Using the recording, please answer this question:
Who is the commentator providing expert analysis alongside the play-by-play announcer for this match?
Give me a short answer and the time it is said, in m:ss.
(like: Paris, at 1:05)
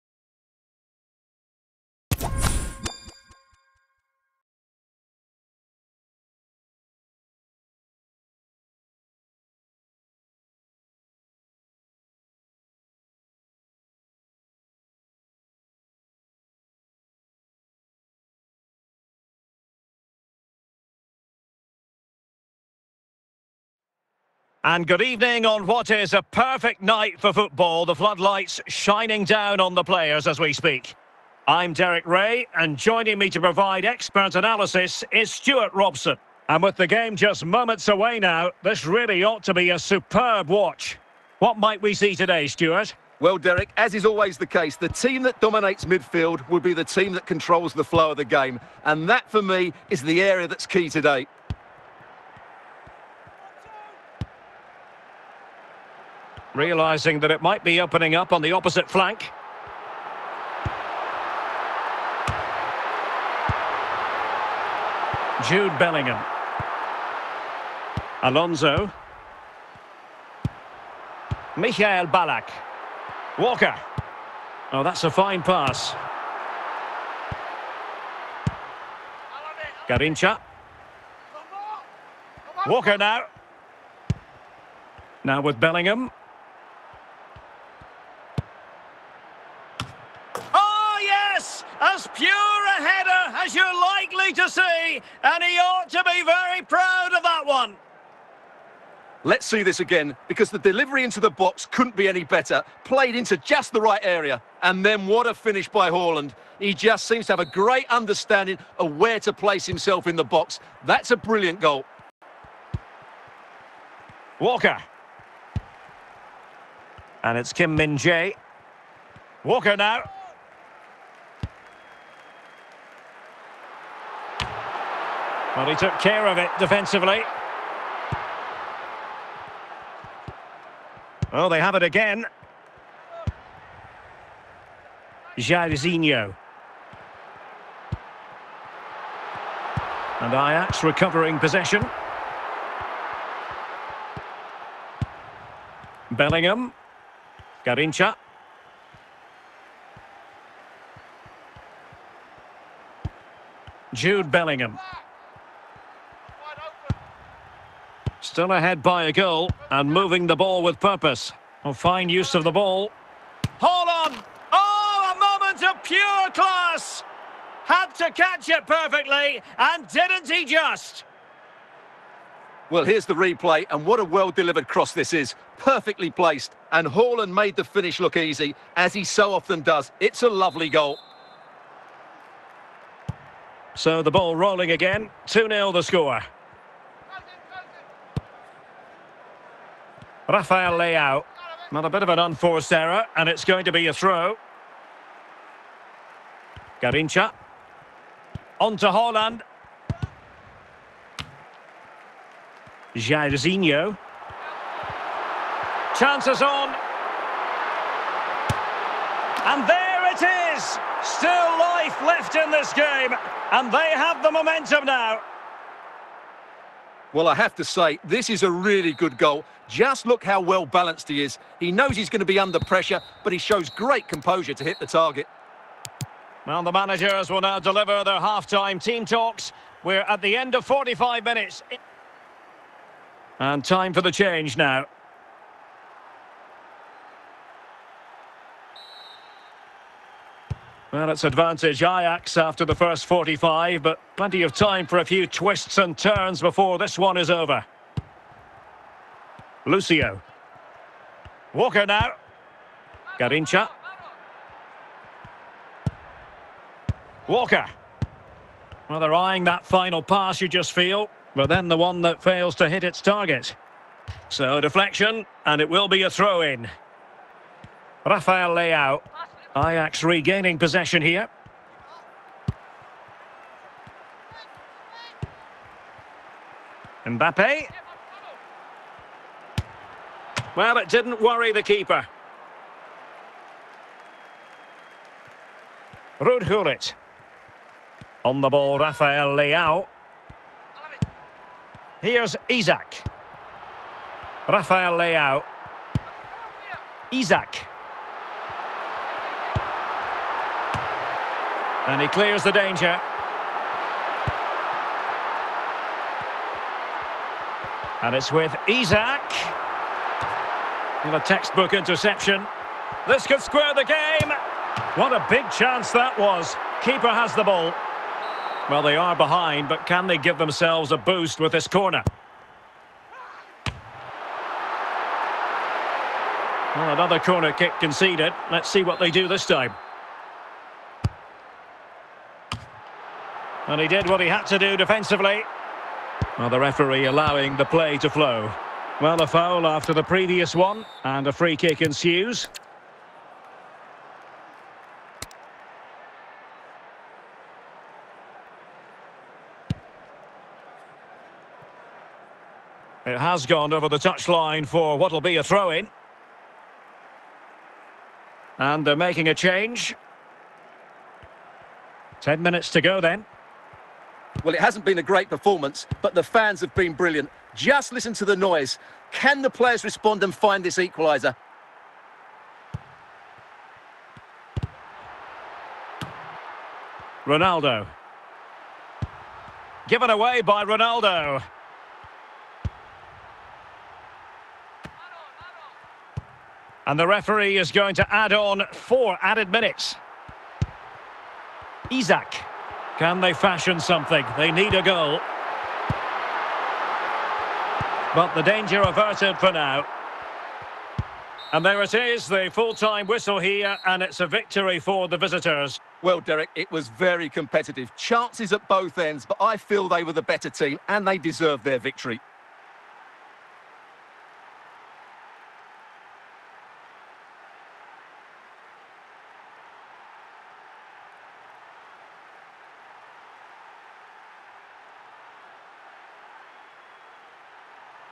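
Stuart Robson, at 0:35.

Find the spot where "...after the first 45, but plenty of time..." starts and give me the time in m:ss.
4:02.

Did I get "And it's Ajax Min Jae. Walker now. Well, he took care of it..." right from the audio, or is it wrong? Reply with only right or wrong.
wrong.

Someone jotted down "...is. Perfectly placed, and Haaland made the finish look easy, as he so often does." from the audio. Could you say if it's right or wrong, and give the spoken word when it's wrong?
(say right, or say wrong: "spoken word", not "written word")
right.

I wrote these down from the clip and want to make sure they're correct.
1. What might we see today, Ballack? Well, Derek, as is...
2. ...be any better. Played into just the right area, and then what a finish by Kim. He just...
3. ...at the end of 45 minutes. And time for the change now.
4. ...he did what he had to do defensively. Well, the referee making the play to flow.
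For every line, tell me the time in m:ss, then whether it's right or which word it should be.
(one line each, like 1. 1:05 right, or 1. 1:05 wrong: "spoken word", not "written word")
1. 0:41 wrong: "Stuart", not "Ballack"
2. 1:41 wrong: "Haaland", not "Kim"
3. 3:50 right
4. 5:33 wrong: "allowing", not "making".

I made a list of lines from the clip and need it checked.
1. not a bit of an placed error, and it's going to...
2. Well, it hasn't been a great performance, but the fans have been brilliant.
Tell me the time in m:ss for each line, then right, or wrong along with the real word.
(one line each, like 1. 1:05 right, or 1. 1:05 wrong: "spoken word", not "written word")
1. 3:11 wrong: "unforced", not "placed"
2. 6:04 right.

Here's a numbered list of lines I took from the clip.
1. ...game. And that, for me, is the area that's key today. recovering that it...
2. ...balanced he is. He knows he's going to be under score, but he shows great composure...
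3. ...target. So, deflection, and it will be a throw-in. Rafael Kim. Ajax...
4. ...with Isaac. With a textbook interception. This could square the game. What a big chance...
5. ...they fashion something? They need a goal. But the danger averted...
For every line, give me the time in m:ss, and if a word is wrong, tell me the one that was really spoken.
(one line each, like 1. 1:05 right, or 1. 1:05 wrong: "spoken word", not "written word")
1. 0:48 wrong: "realising", not "recovering"
2. 3:40 wrong: "pressure", not "score"
3. 4:22 wrong: "Leao", not "Kim"
4. 5:08 right
5. 6:33 right.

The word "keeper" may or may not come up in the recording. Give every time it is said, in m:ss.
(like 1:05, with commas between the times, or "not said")
4:41, 5:16.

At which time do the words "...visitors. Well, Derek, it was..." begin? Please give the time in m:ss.
6:45.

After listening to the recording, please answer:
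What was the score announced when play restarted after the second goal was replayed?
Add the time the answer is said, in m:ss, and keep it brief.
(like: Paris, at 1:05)
2-0, at 3:05.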